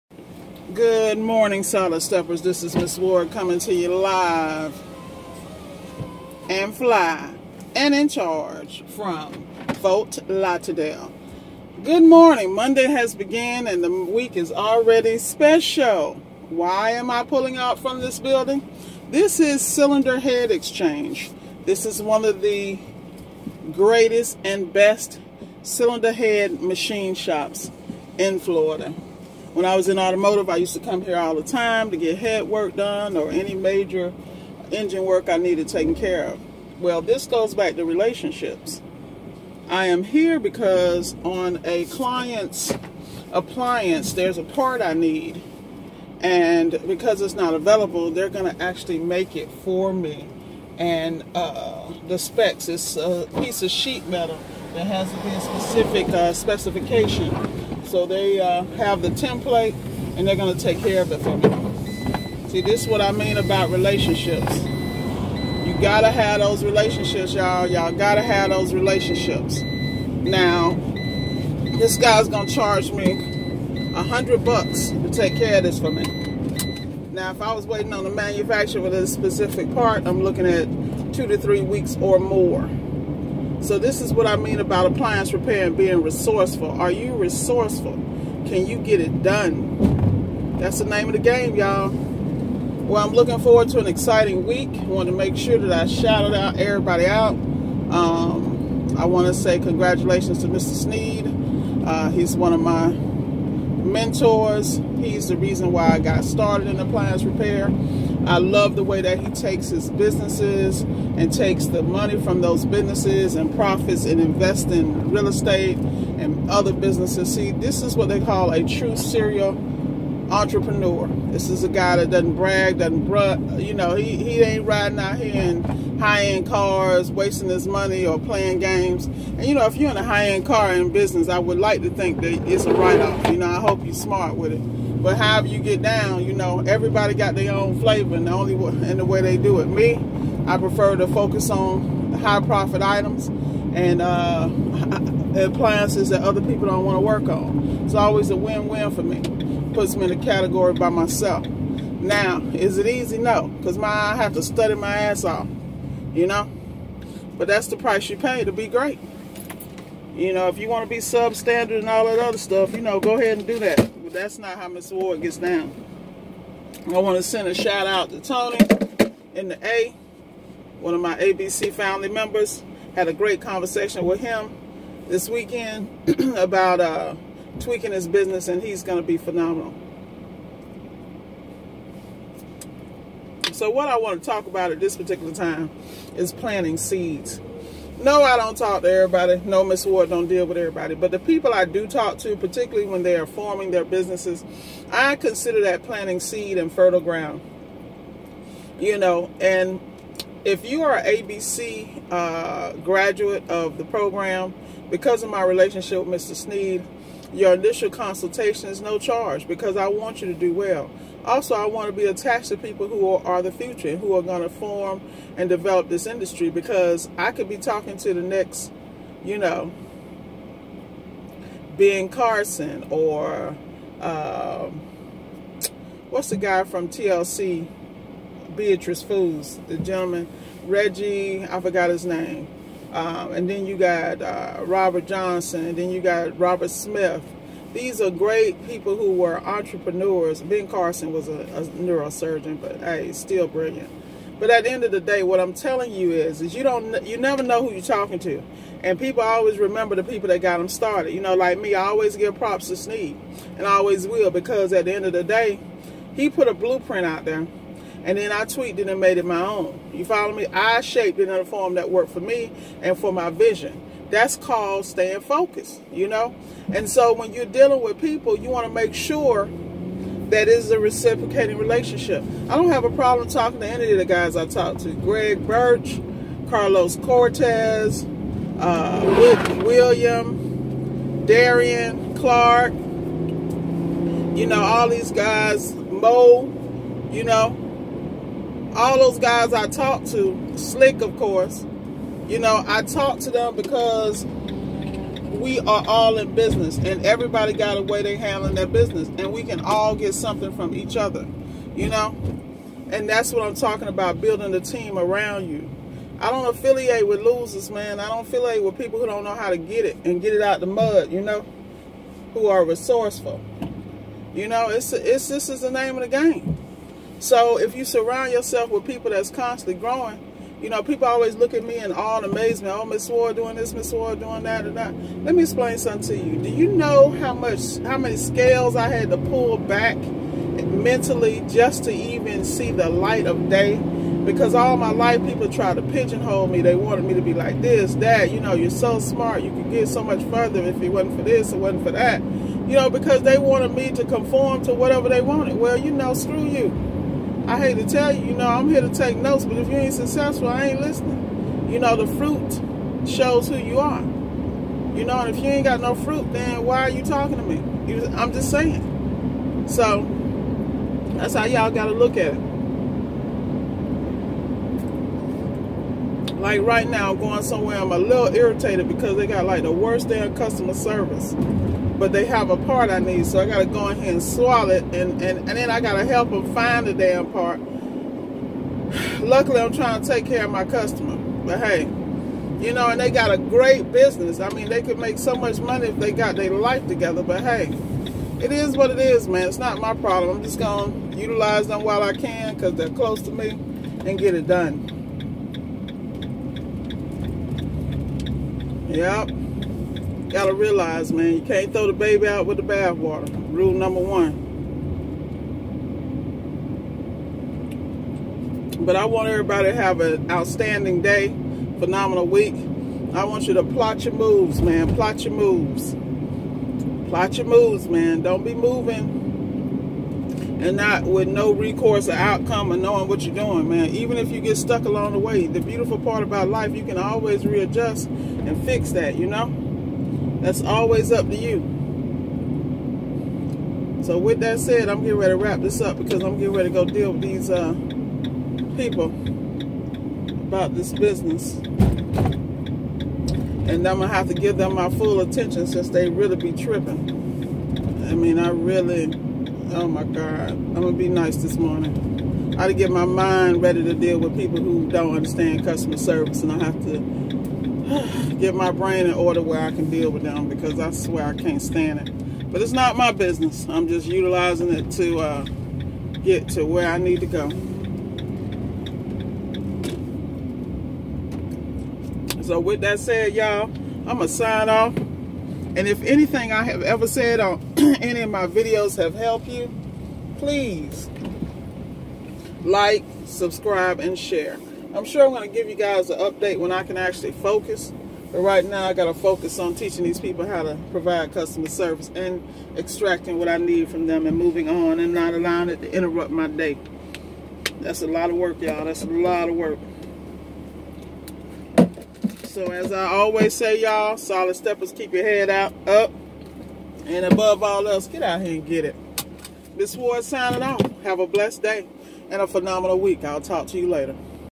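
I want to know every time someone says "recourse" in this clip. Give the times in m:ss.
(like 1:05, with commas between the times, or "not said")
7:01.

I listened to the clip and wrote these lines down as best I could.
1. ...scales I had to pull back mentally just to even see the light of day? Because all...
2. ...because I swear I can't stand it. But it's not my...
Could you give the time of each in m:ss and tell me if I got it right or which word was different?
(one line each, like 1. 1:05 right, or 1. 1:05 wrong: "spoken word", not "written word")
1. 5:28 right
2. 7:40 right.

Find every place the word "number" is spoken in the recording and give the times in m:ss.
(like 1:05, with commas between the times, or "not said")
6:43.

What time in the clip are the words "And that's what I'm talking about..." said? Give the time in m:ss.
5:02.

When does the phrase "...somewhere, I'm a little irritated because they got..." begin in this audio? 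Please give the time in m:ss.
6:07.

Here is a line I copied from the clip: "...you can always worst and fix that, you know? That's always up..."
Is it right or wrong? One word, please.
wrong.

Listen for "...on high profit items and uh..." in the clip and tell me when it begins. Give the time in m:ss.
2:21.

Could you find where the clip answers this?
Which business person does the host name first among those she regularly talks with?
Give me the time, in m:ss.
4:34.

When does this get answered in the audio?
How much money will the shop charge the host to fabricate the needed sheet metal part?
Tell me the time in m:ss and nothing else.
1:13.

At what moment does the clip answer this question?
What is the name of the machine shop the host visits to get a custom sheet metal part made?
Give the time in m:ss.
0:19.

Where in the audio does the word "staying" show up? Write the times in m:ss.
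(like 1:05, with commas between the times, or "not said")
4:24.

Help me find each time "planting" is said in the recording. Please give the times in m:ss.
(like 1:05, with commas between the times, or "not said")
3:06, 3:15.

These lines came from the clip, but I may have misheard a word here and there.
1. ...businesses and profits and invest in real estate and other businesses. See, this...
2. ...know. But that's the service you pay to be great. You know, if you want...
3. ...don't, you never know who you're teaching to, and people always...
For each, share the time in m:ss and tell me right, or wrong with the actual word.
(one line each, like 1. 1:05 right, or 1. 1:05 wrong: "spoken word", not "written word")
1. 1:52 right
2. 2:36 wrong: "price", not "service"
3. 4:06 wrong: "talking", not "teaching".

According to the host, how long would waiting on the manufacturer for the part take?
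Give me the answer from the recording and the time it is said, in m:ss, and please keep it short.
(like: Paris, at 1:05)
2 to 3 weeks, at 1:21.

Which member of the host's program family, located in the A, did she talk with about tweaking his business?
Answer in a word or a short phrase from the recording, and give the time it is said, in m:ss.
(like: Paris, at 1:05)
Tony, at 2:48.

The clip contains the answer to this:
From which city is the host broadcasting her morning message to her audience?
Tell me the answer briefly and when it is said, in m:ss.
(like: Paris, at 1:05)
Fort Lauderdale, at 0:09.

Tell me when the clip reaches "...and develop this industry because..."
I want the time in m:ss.
3:35.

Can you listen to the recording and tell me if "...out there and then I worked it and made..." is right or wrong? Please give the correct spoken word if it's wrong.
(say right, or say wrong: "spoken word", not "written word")
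wrong: "tweaked", not "worked".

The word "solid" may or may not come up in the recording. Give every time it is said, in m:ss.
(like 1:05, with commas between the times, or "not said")
0:01, 8:24.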